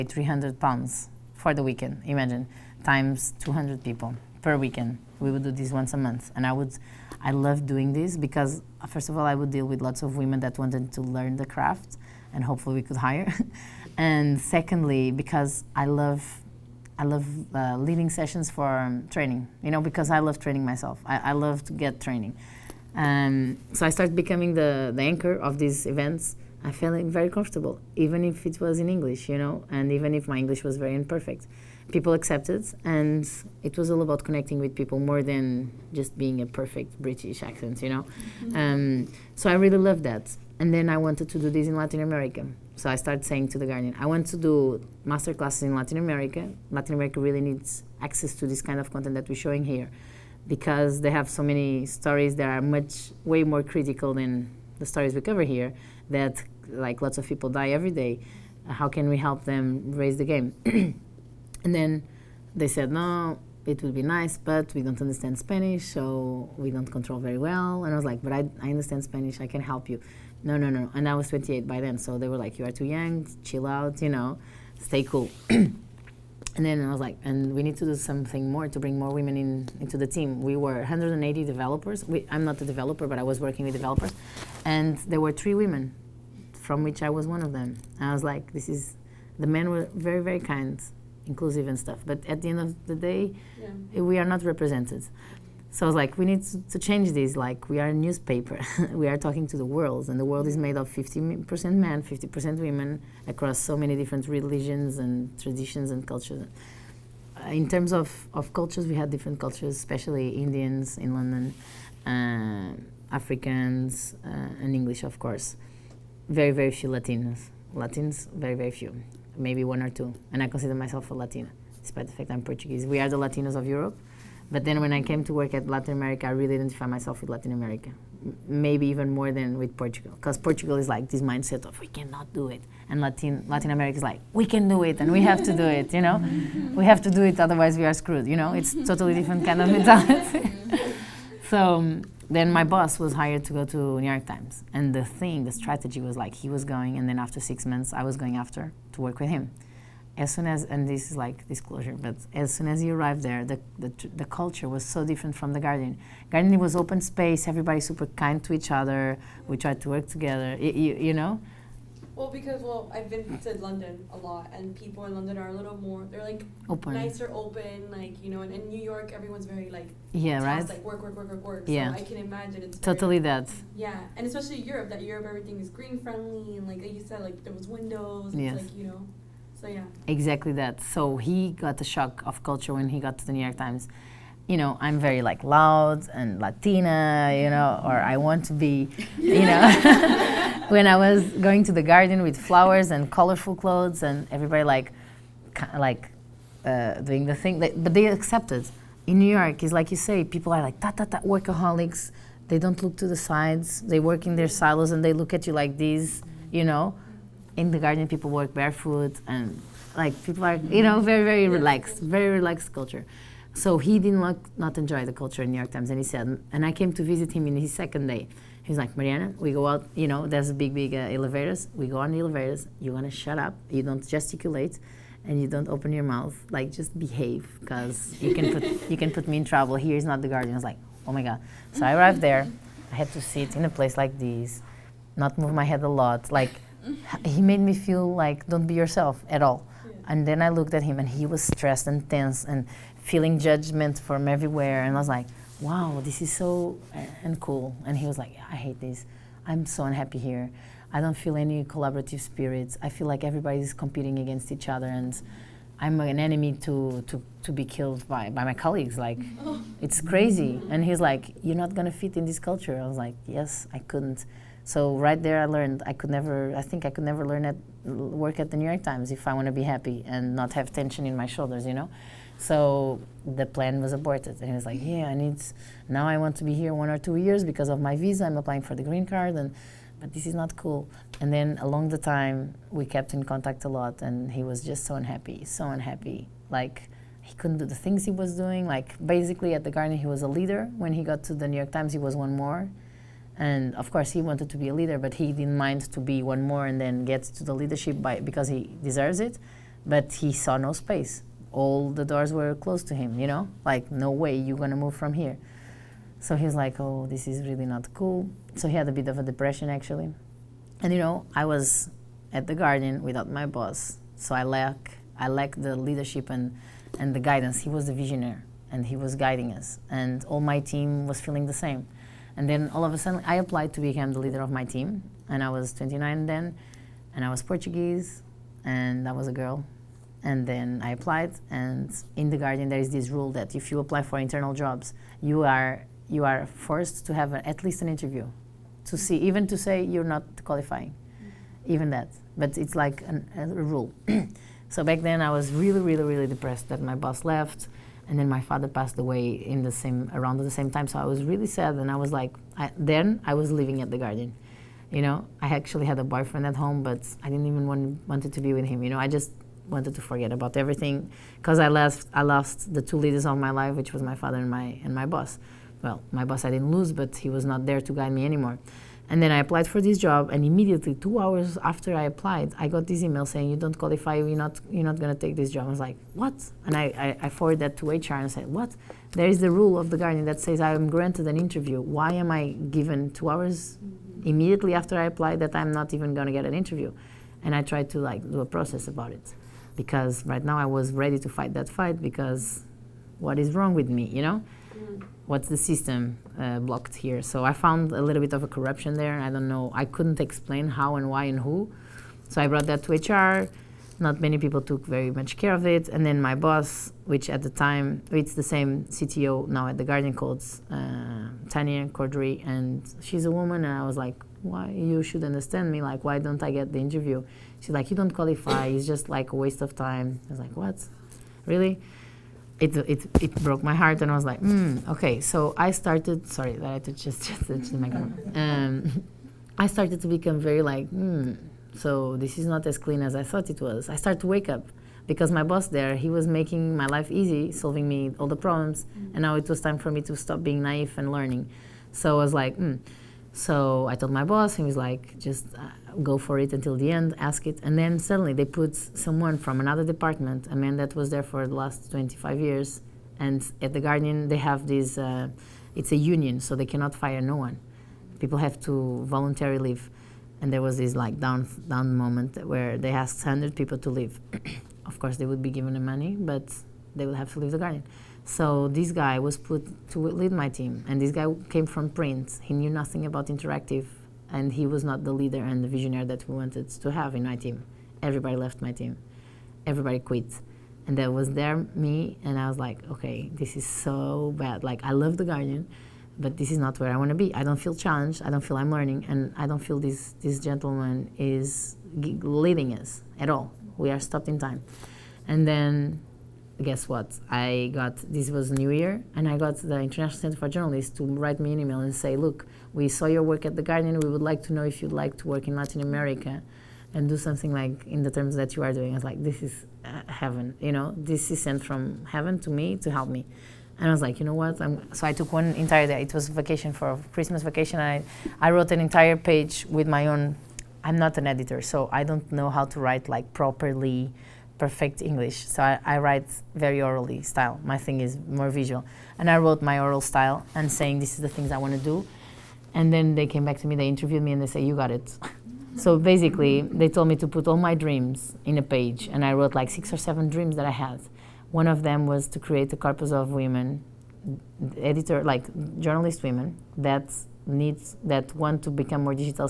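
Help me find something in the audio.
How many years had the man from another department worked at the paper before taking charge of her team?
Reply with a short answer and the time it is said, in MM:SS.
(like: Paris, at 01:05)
25, at 07:31.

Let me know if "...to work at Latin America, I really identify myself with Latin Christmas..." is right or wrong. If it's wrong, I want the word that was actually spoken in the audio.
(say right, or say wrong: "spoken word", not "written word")
wrong: "America", not "Christmas".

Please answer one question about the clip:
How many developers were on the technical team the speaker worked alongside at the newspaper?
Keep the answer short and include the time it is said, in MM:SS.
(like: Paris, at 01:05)
180, at 01:20.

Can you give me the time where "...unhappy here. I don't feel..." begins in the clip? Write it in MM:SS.
04:09.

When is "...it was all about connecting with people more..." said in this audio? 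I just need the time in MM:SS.
00:33.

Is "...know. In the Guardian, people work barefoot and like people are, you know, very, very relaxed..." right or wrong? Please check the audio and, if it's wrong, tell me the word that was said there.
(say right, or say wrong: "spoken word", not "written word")
right.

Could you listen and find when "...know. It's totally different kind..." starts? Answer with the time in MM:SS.
02:18.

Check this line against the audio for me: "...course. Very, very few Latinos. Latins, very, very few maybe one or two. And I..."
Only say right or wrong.
right.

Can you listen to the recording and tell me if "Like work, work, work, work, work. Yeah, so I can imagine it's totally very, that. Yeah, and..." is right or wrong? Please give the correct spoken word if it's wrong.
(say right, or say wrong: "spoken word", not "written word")
right.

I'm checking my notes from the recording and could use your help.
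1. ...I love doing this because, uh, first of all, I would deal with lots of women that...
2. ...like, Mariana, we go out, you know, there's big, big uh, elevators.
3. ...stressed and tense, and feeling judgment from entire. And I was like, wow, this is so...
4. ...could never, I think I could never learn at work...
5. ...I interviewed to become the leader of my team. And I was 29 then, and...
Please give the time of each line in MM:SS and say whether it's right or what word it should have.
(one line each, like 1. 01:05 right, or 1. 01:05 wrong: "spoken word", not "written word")
1. 00:07 right
2. 03:38 right
3. 04:01 wrong: "everywhere", not "entire"
4. 04:25 right
5. 05:23 wrong: "applied", not "interviewed".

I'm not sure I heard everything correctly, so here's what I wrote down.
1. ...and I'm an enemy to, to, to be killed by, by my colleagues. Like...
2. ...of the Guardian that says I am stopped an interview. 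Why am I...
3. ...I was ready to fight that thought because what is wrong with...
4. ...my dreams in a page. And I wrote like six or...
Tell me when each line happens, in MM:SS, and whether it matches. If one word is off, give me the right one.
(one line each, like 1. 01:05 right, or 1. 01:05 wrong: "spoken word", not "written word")
1. 04:14 right
2. 06:19 wrong: "granted", not "stopped"
3. 06:30 wrong: "fight", not "thought"
4. 08:57 right.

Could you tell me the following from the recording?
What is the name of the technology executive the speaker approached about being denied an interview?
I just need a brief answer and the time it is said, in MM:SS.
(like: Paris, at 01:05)
Tanya Cordrey, at 06:51.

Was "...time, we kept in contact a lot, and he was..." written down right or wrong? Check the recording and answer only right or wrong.
right.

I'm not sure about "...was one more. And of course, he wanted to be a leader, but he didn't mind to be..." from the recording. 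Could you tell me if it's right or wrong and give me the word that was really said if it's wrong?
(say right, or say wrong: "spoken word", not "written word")
right.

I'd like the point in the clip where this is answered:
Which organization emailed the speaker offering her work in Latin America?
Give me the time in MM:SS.
08:19.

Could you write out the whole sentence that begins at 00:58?
How can we help them raise the game?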